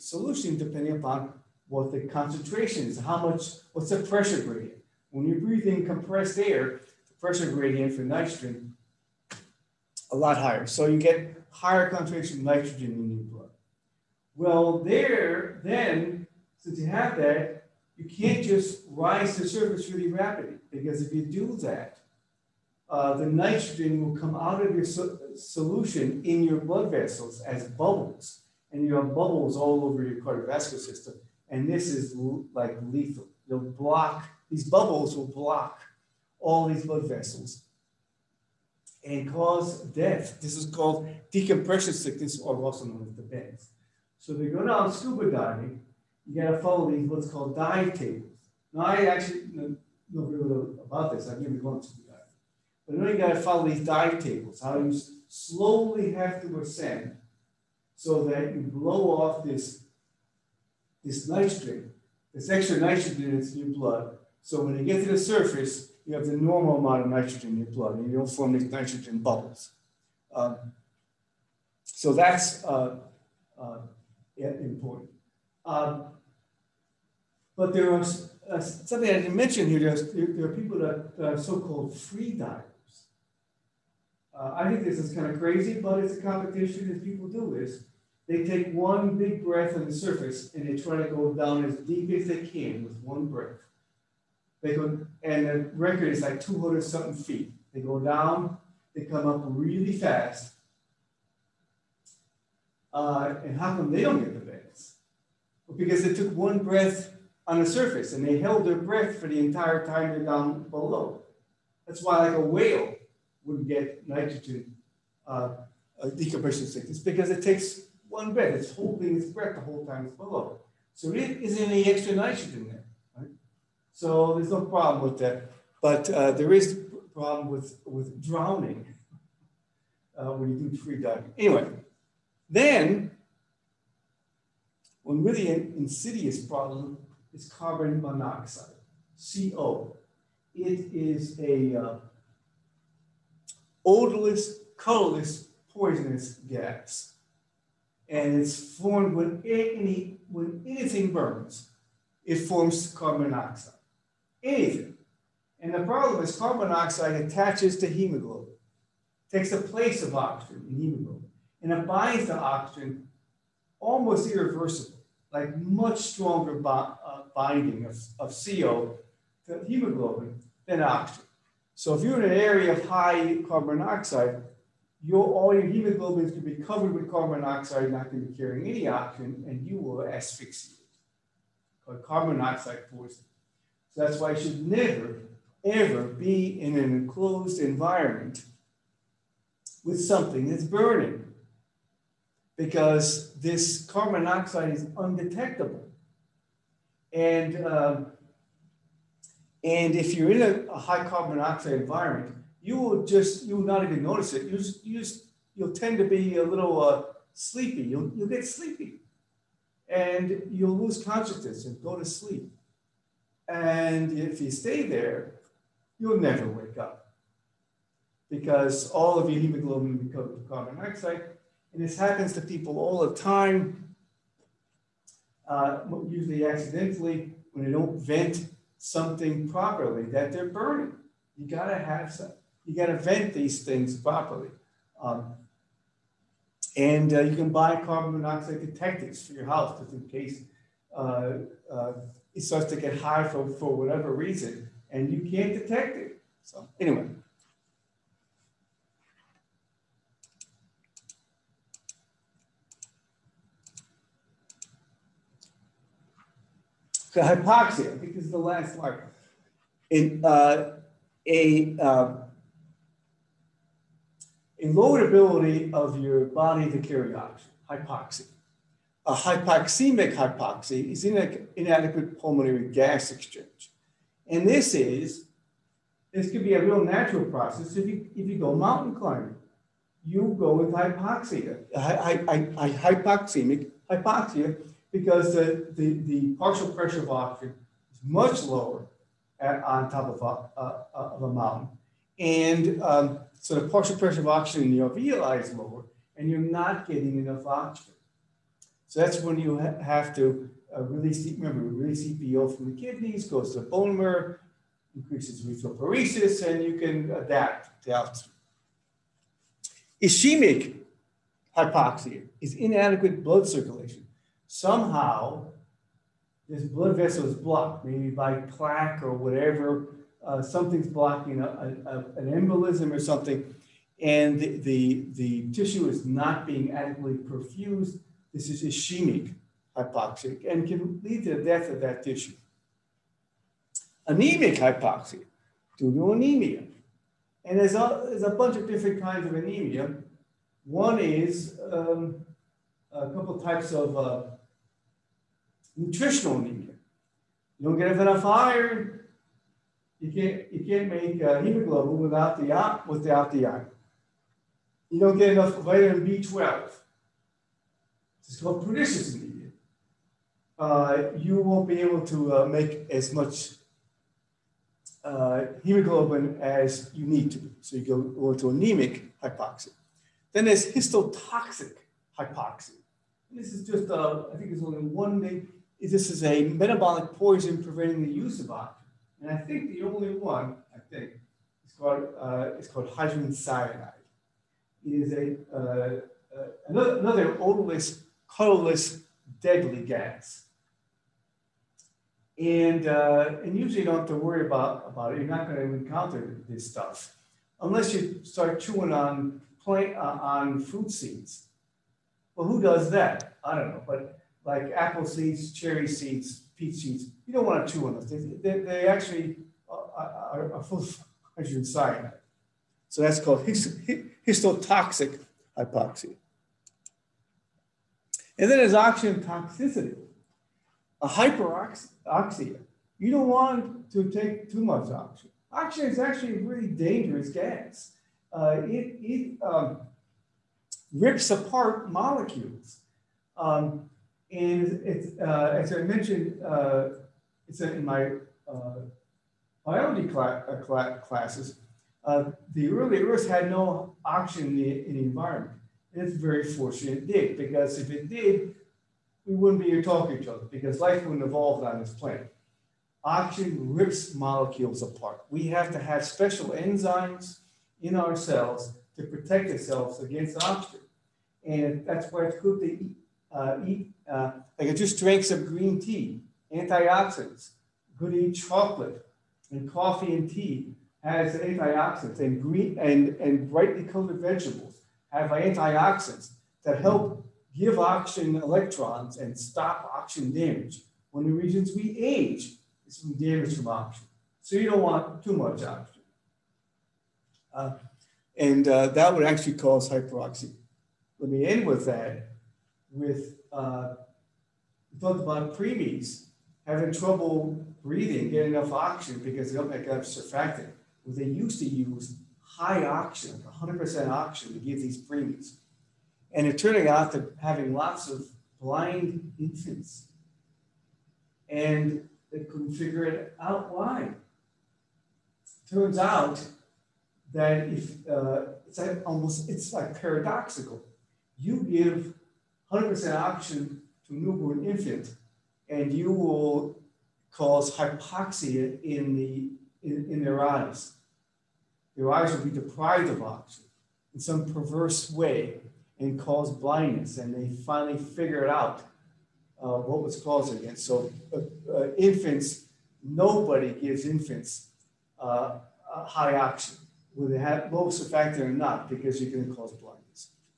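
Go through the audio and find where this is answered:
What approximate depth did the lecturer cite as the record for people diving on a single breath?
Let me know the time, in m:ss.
1:36.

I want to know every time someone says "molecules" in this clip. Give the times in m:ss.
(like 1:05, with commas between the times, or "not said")
7:11, 7:34.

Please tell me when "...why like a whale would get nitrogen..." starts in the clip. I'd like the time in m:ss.
1:52.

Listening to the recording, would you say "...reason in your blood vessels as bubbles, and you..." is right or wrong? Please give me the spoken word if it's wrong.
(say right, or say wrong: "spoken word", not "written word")
wrong: "solution", not "reason".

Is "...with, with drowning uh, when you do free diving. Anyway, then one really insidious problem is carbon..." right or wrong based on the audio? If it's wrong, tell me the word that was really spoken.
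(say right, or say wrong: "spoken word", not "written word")
right.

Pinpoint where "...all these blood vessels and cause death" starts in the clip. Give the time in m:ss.
0:36.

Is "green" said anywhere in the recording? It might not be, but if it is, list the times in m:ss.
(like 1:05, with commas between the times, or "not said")
7:45, 7:52.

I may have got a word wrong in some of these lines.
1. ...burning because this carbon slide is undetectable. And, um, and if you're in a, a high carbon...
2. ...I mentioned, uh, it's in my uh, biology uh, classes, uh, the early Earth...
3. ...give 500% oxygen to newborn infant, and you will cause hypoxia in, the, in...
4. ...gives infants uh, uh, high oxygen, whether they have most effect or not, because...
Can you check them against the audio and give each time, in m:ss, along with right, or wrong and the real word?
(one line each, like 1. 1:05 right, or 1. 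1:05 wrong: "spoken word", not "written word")
1. 3:10 wrong: "monoxide", not "slide"
2. 7:15 right
3. 8:41 wrong: "100", not "500"
4. 9:03 right.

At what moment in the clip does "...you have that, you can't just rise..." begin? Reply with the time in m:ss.
0:16.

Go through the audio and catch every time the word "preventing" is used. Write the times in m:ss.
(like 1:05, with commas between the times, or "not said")
6:17.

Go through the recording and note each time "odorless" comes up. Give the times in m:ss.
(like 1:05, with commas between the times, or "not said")
2:23, 6:27.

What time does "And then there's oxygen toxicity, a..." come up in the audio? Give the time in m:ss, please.
6:58.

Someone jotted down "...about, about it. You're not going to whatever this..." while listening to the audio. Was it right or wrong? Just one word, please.
wrong.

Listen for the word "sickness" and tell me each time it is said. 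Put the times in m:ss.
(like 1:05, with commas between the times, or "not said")
0:41, 1:56.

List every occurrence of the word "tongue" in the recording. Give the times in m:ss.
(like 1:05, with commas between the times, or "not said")
not said.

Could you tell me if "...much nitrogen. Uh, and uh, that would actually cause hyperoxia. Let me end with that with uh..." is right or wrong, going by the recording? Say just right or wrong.
wrong.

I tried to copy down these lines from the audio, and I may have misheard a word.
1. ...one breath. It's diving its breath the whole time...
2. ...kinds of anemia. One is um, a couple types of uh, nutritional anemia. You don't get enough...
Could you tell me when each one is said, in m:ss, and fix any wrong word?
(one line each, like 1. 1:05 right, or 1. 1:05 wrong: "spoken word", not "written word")
1. 1:58 wrong: "holding", not "diving"
2. 5:39 right.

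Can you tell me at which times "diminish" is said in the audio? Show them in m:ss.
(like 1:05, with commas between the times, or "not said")
not said.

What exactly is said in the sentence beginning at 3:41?
And this happens to people all the time, uh, usually accidentally, when they don't vent something properly that they're burning.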